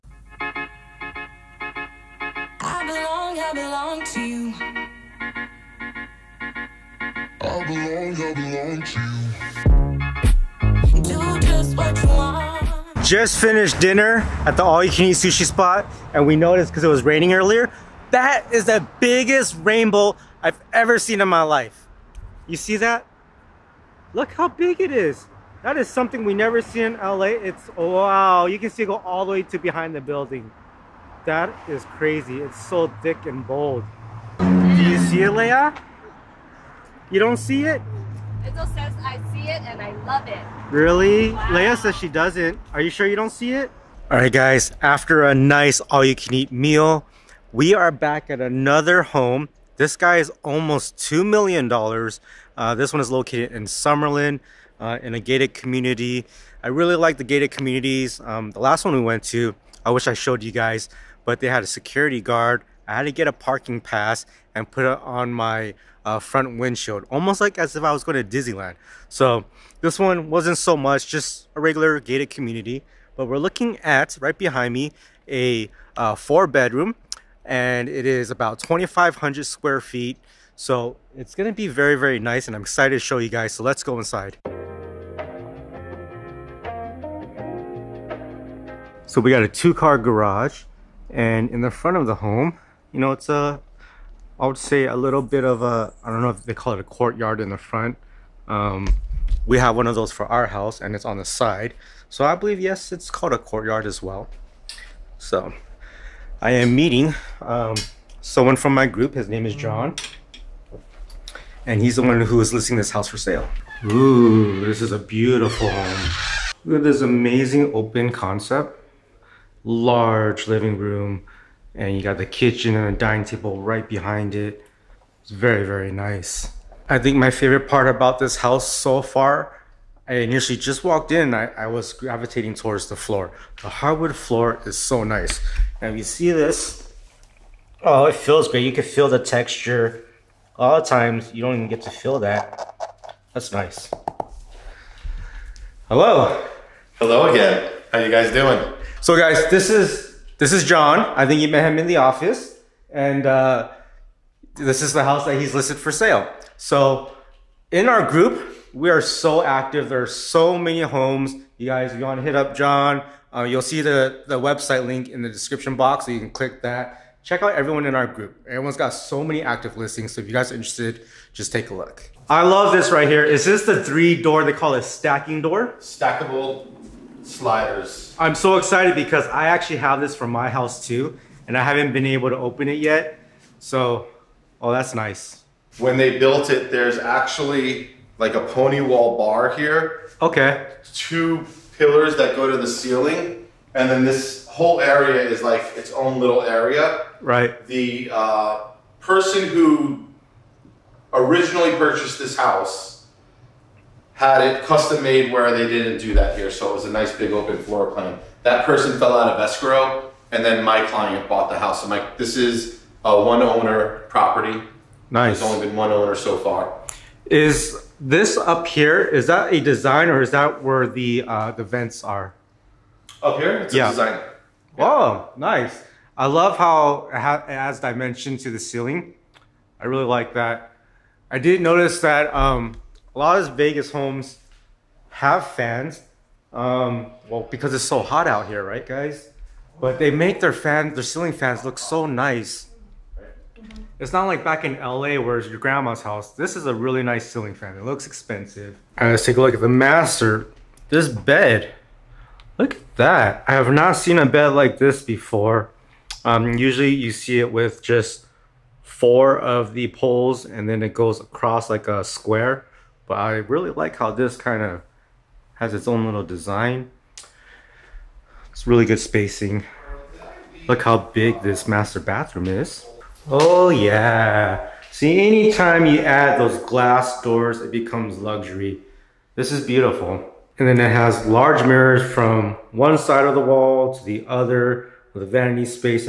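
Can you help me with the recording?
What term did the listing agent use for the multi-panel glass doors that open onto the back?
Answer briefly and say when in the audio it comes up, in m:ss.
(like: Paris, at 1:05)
Stackable sliders, at 2:55.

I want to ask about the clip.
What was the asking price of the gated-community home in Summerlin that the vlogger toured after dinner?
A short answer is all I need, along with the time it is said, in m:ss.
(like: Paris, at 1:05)
almost $2 million, at 0:50.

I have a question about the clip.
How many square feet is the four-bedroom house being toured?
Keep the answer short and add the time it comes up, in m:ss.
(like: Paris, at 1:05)
2,500, at 1:18.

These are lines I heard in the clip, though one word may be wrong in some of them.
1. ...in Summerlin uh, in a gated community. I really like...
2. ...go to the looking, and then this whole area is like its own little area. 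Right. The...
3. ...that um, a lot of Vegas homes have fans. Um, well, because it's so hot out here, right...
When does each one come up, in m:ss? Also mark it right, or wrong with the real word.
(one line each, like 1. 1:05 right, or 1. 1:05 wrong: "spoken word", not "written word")
1. 0:53 right
2. 3:12 wrong: "ceiling", not "looking"
3. 3:51 right.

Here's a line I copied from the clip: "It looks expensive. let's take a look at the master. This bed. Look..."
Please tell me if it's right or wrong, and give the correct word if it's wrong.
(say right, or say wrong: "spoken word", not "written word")
right.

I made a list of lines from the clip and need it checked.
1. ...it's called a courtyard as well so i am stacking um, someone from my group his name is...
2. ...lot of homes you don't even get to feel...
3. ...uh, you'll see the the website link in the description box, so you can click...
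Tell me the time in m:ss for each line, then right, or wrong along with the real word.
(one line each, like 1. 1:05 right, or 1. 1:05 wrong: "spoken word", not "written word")
1. 1:42 wrong: "meeting", not "stacking"
2. 2:20 wrong: "times", not "homes"
3. 2:43 right.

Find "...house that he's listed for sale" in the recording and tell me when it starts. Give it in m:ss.
2:35.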